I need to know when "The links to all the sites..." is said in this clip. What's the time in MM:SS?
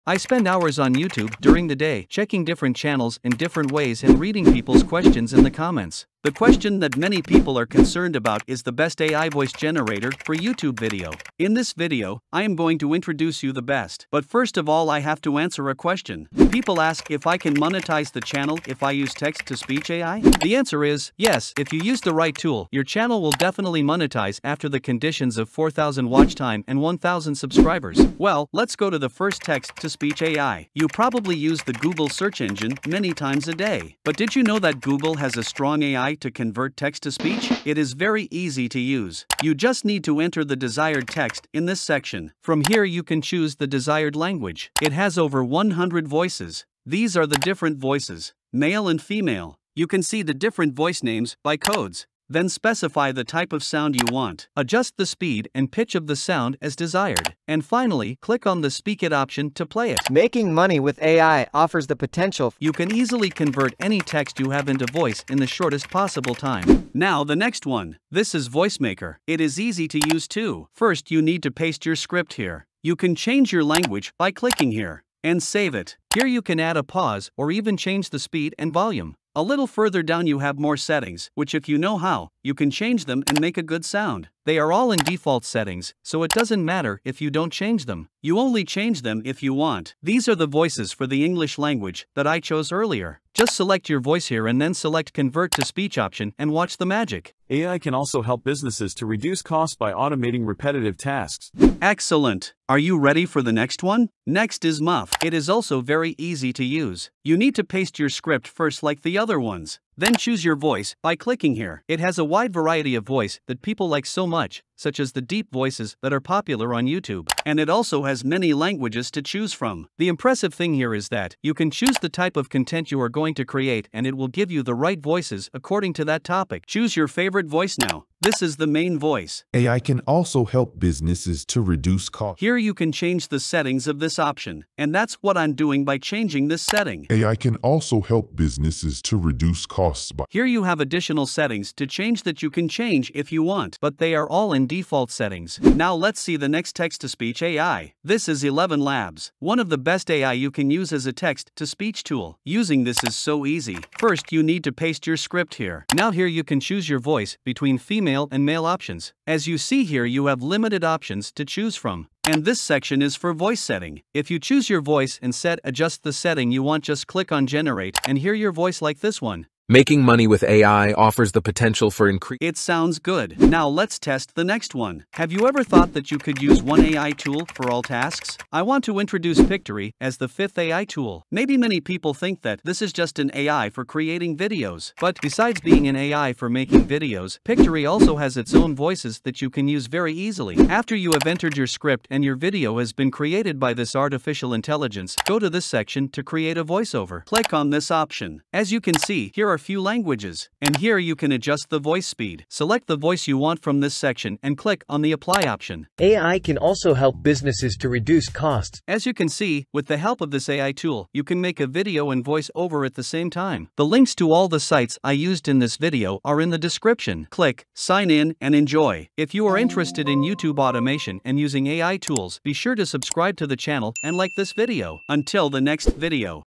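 03:33.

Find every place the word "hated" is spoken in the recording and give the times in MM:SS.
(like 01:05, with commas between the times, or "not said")
not said.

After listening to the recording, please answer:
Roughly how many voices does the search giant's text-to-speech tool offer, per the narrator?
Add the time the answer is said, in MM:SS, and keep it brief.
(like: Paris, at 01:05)
over 100, at 00:45.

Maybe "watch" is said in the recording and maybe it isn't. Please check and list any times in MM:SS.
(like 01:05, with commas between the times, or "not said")
00:26, 01:36.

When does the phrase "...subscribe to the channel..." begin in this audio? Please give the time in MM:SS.
03:42.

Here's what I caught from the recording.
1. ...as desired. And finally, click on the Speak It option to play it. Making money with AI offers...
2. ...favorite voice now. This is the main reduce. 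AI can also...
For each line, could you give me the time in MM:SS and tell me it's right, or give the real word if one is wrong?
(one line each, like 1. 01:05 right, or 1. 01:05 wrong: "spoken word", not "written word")
1. 00:56 right
2. 02:07 wrong: "voice", not "reduce".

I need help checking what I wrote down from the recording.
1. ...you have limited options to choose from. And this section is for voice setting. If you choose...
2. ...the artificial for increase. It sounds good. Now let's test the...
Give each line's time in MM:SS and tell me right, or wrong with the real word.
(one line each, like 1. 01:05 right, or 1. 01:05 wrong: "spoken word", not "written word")
1. 02:40 right
2. 02:51 wrong: "potential", not "artificial".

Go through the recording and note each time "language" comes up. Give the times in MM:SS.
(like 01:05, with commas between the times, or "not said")
00:44, 01:13, 01:31, 01:58, 03:19.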